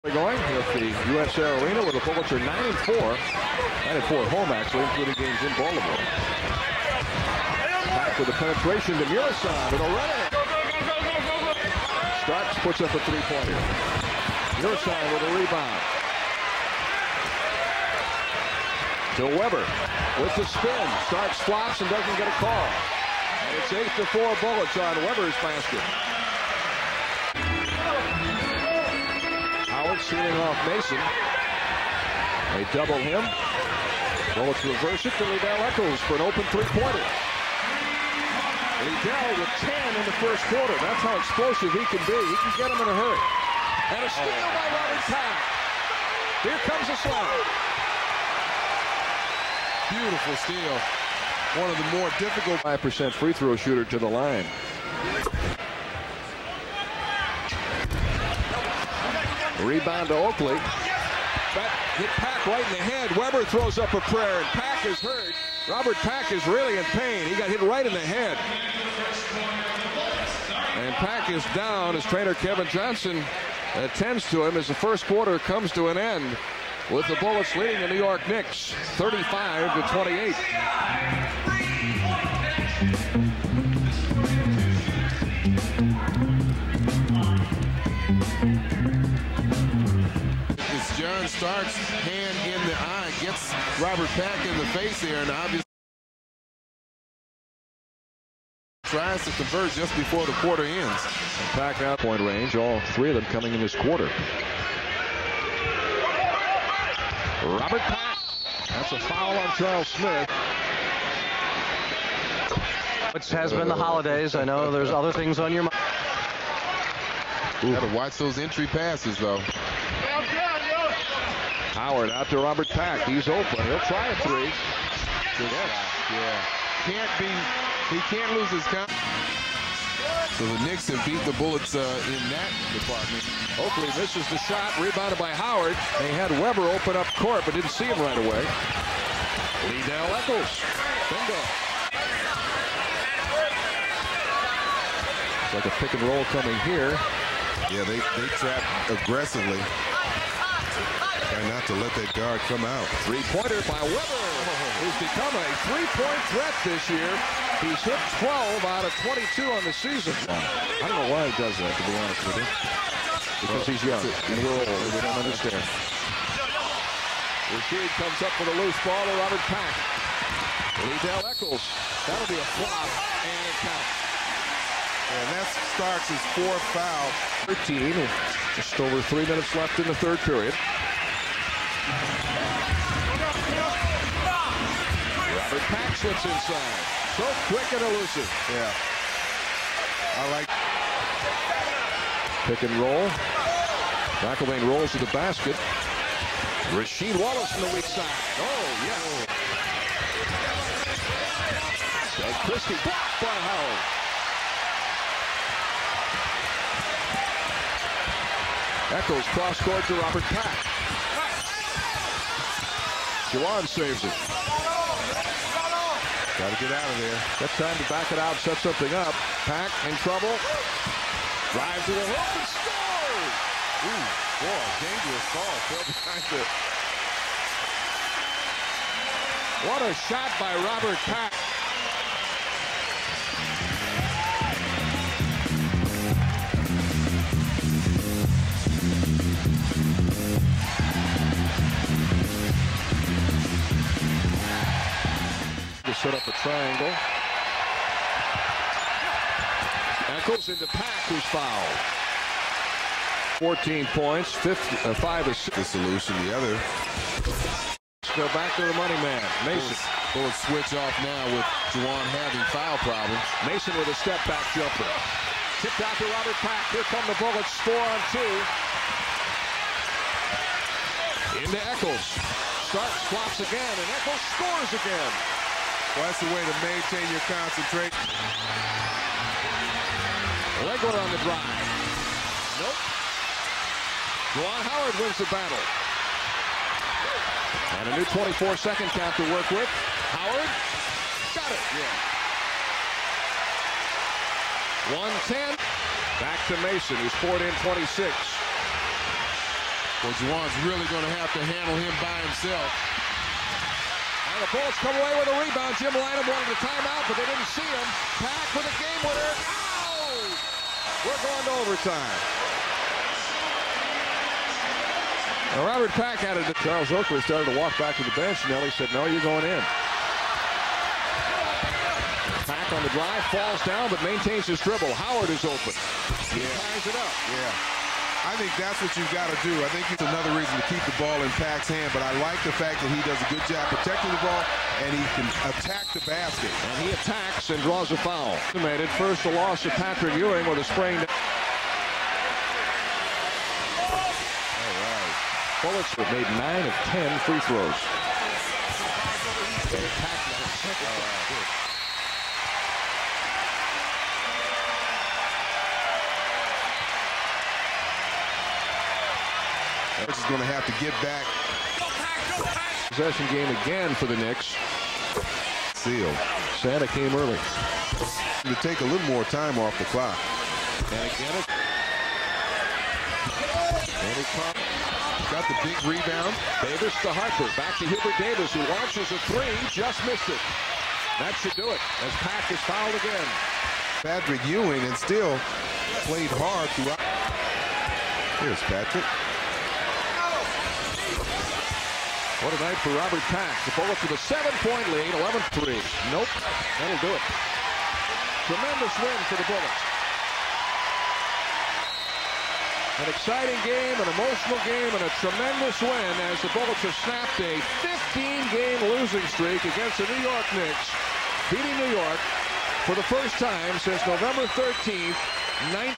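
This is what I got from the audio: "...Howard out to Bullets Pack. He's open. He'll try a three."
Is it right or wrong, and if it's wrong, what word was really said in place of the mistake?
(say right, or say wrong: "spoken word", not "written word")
wrong: "Robert", not "Bullets".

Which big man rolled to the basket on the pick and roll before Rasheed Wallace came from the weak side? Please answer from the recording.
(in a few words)
McIlvaine.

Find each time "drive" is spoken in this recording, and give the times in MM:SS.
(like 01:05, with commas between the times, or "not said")
03:41, 04:41, 05:22.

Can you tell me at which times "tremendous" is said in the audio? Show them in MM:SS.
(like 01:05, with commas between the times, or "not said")
06:38, 06:45.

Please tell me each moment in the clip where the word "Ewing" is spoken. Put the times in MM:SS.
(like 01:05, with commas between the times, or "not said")
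05:40, 06:24.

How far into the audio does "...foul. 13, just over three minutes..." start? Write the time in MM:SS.
02:56.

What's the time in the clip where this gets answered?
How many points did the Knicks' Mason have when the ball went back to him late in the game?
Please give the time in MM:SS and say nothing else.
04:57.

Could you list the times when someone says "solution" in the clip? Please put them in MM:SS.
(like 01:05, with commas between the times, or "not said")
04:15.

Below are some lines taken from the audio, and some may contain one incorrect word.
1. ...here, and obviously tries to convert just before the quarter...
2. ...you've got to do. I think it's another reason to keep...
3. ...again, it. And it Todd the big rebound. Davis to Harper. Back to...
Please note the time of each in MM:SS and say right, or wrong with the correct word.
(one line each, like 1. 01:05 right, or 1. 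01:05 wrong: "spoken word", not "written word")
1. 01:35 right
2. 05:28 right
3. 06:11 wrong: "Got", not "Todd".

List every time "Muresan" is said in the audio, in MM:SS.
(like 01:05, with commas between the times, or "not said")
00:09, 00:14.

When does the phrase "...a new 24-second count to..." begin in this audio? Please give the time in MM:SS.
04:47.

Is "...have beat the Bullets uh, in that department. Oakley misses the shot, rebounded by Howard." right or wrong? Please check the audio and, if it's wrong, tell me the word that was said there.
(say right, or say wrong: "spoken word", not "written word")
right.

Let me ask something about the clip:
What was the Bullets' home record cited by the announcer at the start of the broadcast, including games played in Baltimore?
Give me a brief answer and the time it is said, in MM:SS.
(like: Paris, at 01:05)
9 and 4, at 00:02.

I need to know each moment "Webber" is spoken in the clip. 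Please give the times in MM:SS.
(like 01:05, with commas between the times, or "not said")
00:19, 00:25, 01:03, 02:16, 02:33.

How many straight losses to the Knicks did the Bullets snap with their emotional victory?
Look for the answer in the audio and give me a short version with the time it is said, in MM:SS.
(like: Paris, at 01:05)
15, at 06:47.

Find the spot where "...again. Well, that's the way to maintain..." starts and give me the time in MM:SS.
04:34.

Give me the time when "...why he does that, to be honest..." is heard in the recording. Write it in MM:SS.
02:41.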